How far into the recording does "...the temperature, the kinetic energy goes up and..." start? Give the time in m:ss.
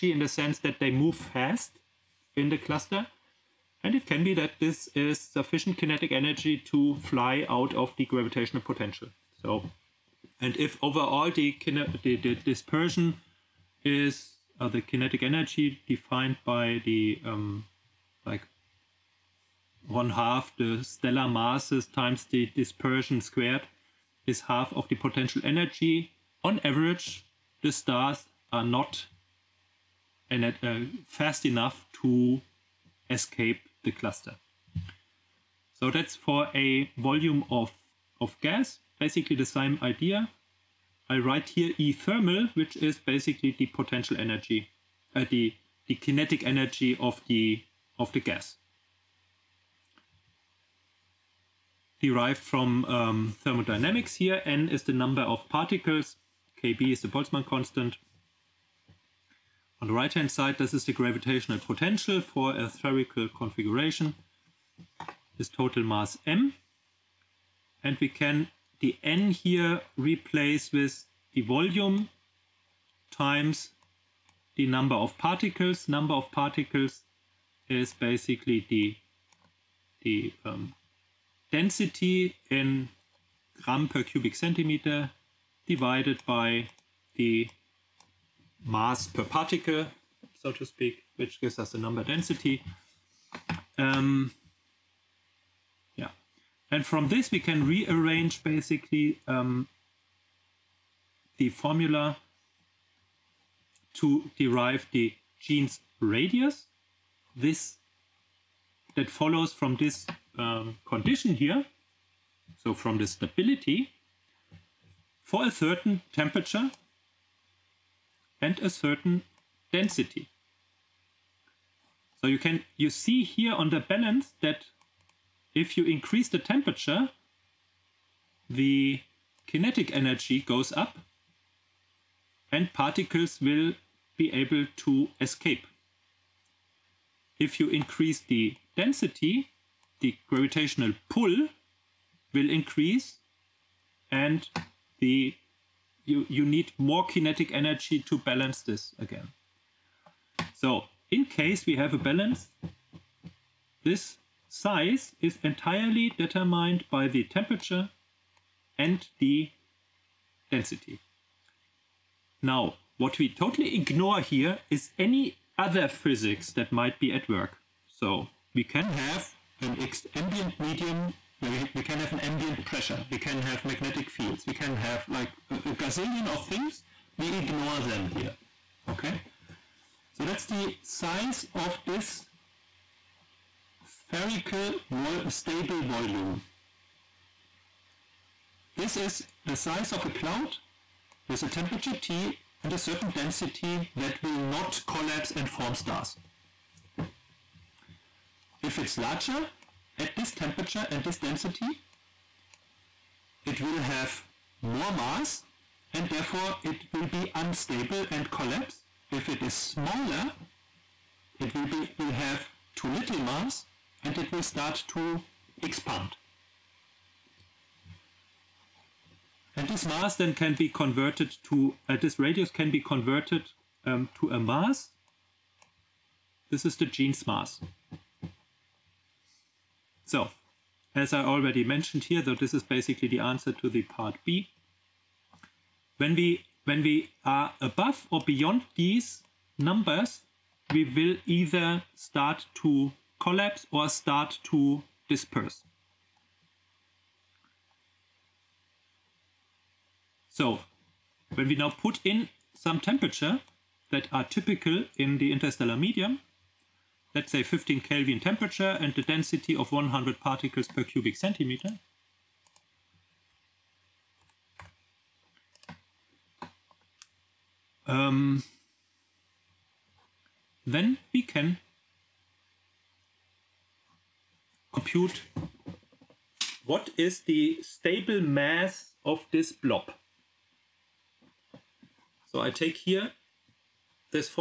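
2:06.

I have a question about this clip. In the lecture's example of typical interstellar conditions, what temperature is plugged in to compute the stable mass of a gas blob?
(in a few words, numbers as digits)
15 Kelvin.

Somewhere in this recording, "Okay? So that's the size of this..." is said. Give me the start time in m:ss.
2:58.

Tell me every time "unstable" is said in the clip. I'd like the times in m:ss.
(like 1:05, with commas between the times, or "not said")
3:27.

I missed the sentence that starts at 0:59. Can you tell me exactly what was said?
On the right-hand side, this is the gravitational potential for a spherical configuration, is total mass m.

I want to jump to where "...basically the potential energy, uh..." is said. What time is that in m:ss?
0:42.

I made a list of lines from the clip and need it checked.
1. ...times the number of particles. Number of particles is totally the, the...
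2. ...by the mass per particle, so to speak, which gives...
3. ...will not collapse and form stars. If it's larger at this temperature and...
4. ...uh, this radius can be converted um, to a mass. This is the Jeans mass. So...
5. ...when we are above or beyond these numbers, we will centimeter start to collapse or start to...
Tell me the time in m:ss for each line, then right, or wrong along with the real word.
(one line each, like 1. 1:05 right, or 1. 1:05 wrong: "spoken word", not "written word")
1. 1:13 wrong: "basically", not "totally"
2. 1:26 right
3. 3:14 right
4. 3:41 right
5. 3:56 wrong: "either", not "centimeter".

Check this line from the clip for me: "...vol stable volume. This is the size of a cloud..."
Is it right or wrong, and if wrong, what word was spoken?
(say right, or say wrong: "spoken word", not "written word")
right.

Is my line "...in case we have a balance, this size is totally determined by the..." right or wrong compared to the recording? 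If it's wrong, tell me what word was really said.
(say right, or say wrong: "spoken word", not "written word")
wrong: "entirely", not "totally".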